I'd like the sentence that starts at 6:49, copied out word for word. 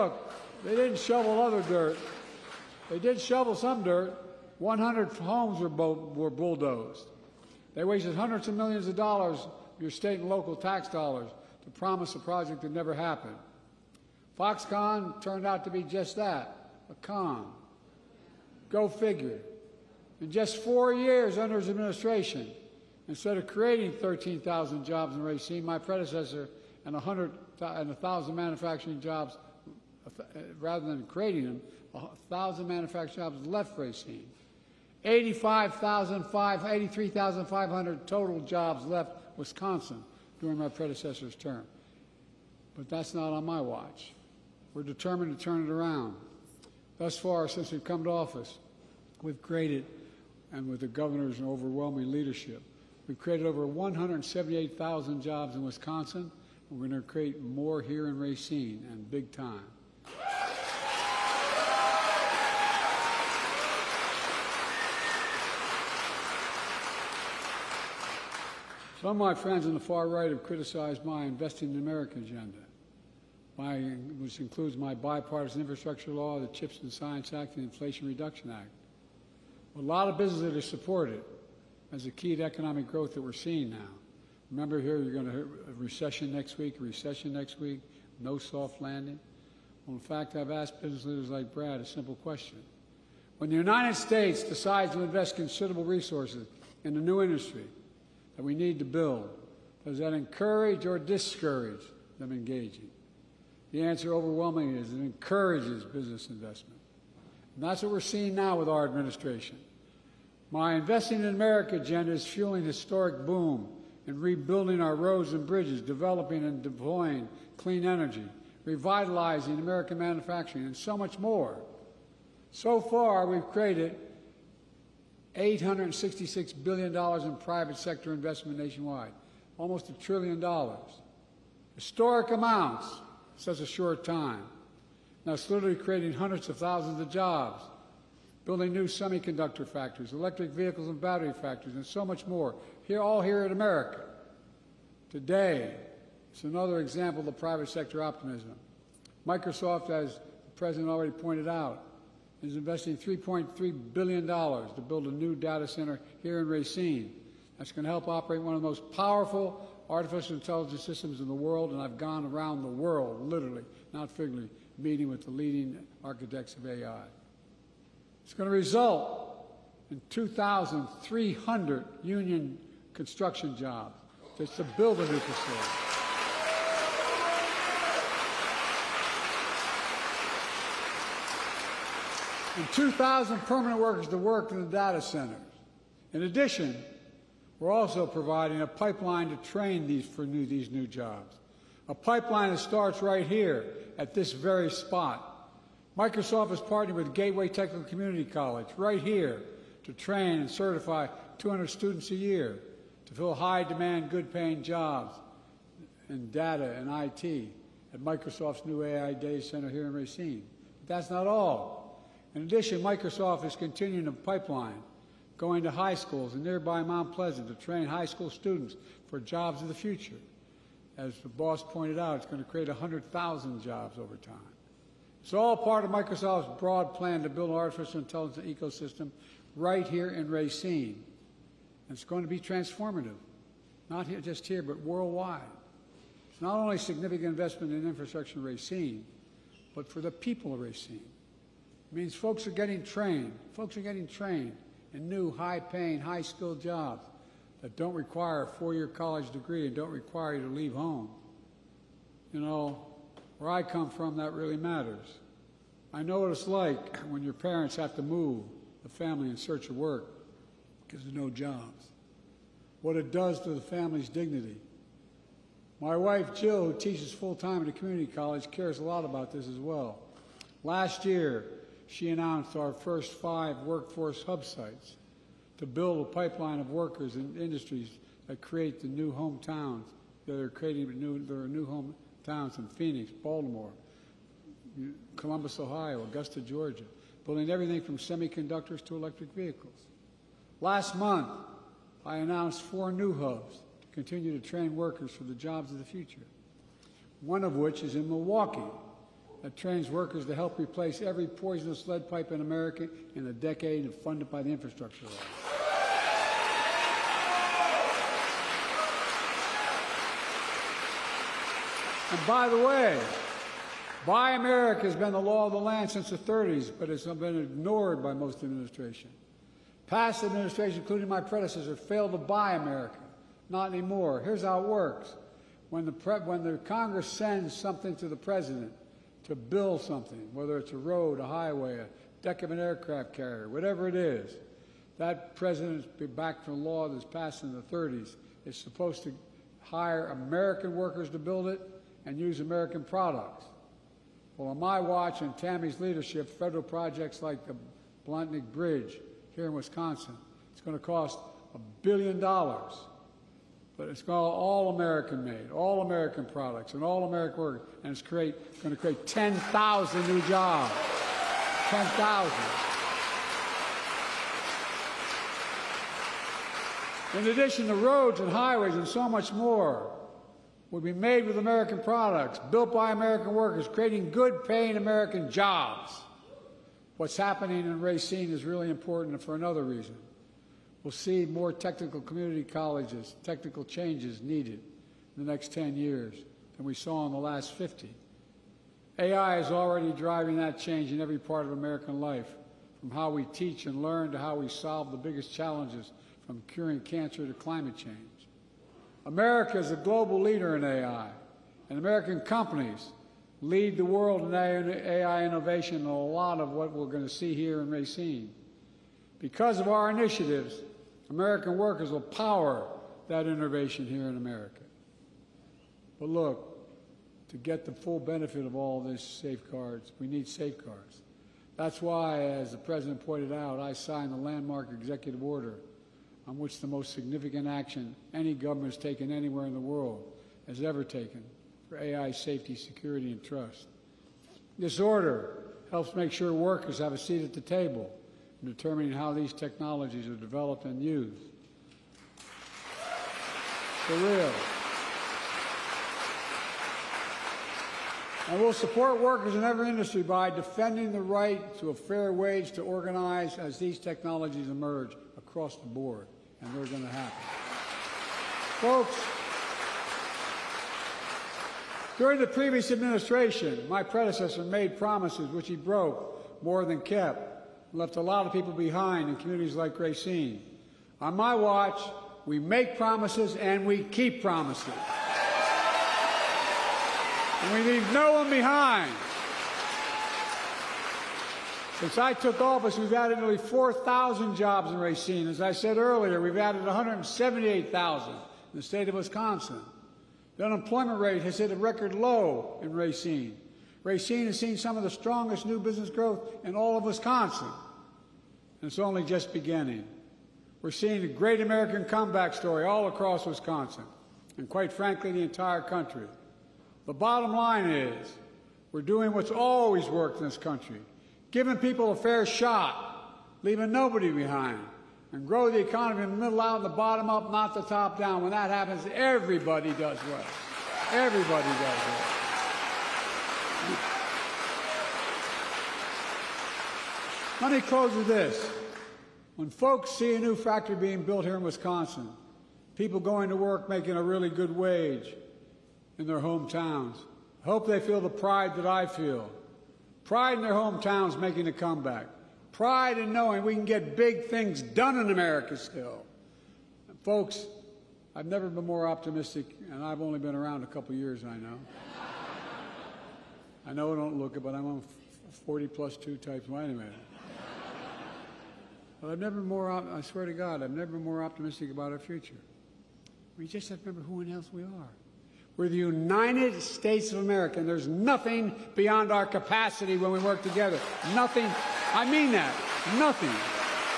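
Because of our initiatives, American workers will power that innovation here in America.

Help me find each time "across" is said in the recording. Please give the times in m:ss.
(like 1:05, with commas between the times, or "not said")
7:35, 8:22.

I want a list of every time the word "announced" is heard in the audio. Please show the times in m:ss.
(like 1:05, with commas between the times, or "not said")
4:32, 4:52.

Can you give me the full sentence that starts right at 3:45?
It's all part of Microsoft's broad plan to build an artificial intelligence ecosystem right here in Racine.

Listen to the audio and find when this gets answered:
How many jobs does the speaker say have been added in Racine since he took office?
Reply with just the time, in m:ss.
8:03.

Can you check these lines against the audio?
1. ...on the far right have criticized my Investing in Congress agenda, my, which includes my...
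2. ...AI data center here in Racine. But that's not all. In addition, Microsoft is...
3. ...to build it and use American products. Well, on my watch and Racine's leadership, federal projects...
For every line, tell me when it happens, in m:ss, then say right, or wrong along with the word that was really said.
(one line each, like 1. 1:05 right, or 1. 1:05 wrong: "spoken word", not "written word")
1. 1:09 wrong: "America", not "Congress"
2. 3:28 right
3. 5:41 wrong: "Tammy", not "Racine".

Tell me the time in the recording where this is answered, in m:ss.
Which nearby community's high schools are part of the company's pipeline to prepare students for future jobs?
3:36.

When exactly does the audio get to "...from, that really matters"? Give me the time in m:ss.
4:13.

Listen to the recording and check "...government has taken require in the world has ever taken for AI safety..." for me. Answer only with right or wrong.
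wrong.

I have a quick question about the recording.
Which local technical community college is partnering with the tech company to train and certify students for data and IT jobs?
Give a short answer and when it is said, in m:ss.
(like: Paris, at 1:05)
Gateway Technical Community College, at 3:17.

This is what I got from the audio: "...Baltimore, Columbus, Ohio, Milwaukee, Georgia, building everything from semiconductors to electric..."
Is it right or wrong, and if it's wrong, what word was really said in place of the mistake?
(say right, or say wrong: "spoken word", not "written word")
wrong: "Augusta", not "Milwaukee".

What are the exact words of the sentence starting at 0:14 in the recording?
Foxconn turned out to be just that, a con.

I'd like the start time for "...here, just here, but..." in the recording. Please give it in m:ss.
3:54.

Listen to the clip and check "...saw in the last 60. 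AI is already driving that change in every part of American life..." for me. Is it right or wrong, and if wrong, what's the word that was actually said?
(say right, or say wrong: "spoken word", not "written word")
wrong: "50", not "60".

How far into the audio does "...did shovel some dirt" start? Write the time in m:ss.
0:02.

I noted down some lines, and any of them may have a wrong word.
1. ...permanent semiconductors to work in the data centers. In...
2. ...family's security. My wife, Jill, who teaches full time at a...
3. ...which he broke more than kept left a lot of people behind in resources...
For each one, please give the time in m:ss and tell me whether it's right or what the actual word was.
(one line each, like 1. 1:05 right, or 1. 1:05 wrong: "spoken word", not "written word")
1. 3:03 wrong: "workers", not "semiconductors"
2. 4:23 wrong: "dignity", not "security"
3. 7:45 wrong: "communities", not "resources".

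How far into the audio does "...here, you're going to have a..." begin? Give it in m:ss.
1:24.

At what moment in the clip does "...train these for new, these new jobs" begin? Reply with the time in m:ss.
3:09.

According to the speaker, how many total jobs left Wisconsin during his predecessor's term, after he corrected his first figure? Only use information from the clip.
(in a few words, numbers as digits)
83,500.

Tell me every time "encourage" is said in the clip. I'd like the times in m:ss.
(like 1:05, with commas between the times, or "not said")
1:40, 1:44.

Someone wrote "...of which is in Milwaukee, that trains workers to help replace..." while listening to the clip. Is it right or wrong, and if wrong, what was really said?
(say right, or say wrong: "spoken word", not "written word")
right.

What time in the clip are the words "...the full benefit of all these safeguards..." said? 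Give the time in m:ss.
6:57.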